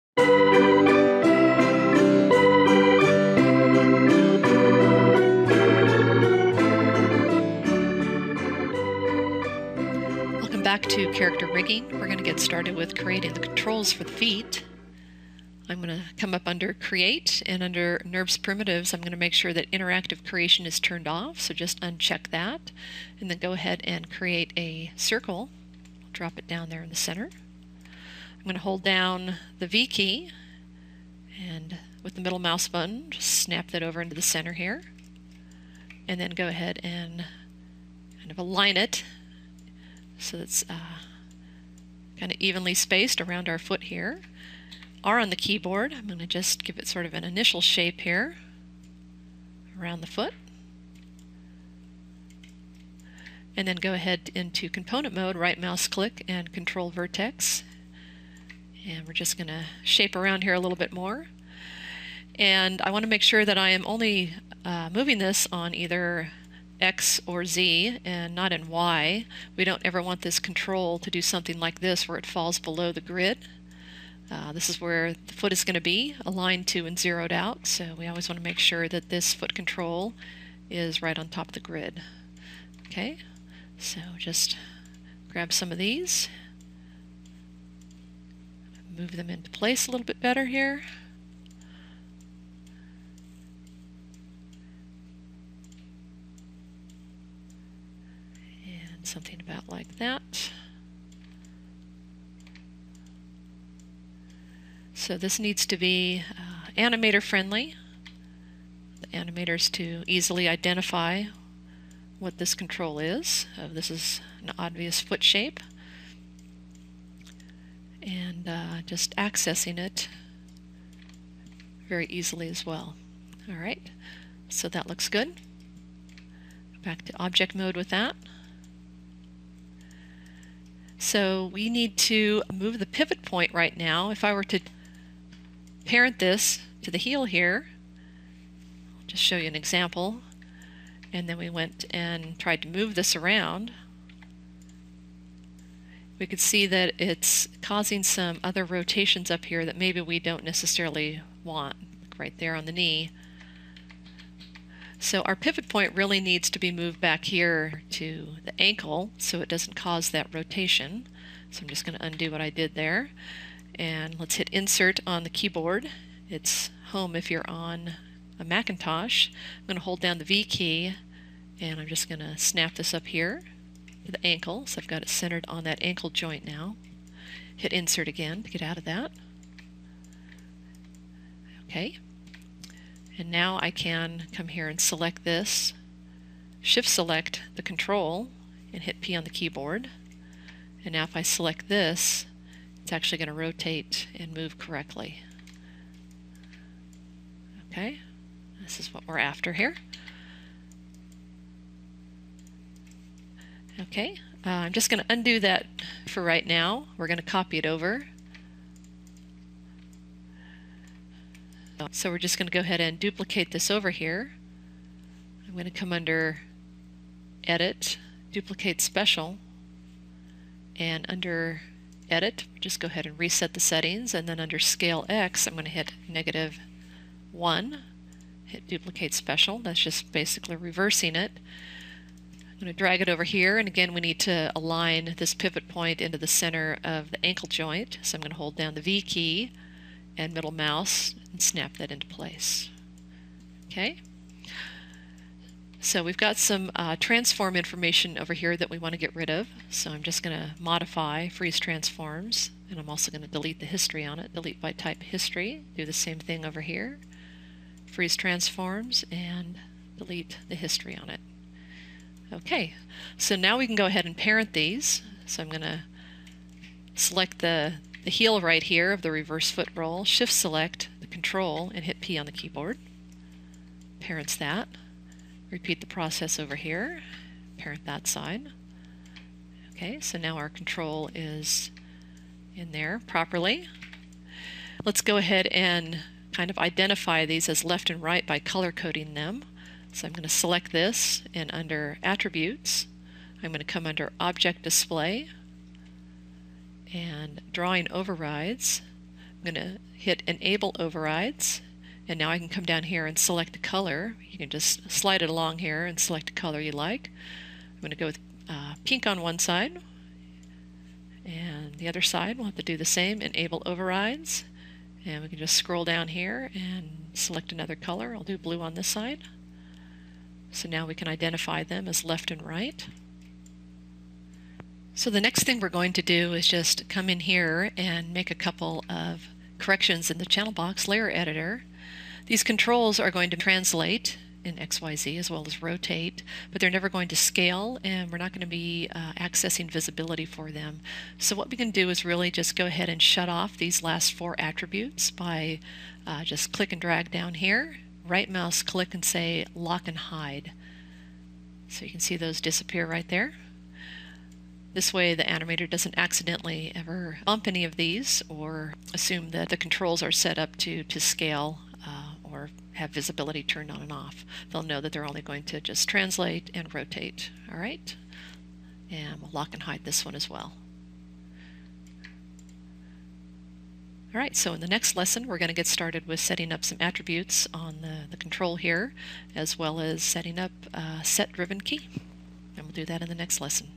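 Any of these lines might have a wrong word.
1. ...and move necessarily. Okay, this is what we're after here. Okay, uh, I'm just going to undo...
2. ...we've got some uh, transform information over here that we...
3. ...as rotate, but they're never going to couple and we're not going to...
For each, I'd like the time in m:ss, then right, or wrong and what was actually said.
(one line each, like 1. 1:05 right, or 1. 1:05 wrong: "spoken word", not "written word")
1. 3:14 wrong: "correctly", not "necessarily"
2. 4:06 right
3. 5:35 wrong: "scale", not "couple".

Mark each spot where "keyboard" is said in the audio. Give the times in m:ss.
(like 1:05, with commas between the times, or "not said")
0:45, 2:45, 3:09, 4:32.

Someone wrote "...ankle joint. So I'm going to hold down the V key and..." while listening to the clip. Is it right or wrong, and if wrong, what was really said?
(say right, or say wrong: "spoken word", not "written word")
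right.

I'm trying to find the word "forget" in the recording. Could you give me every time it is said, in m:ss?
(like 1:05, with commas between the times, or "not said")
not said.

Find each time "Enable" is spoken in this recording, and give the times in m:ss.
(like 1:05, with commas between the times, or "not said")
5:00, 5:13.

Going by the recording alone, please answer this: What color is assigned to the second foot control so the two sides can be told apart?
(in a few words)
Blue.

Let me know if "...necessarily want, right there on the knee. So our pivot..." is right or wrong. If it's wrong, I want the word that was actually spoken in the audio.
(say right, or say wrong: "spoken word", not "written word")
right.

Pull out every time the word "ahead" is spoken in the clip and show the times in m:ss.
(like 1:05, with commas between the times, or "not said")
0:23, 0:36, 0:53, 3:32, 3:42, 4:23, 4:45, 5:42.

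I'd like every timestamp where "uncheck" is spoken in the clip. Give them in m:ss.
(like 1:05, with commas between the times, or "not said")
0:21.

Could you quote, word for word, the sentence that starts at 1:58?
And uh, just accessing it very easily as well.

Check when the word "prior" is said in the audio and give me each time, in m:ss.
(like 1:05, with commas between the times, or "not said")
not said.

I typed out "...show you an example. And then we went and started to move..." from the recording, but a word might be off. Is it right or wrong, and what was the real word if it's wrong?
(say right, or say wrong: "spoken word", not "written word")
wrong: "tried", not "started".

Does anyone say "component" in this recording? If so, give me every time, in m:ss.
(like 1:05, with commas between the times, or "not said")
0:54.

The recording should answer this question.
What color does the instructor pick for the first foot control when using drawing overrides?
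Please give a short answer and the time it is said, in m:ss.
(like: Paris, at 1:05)
Pink, at 5:08.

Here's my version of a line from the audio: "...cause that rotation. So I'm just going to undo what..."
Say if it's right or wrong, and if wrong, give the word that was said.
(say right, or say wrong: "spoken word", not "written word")
right.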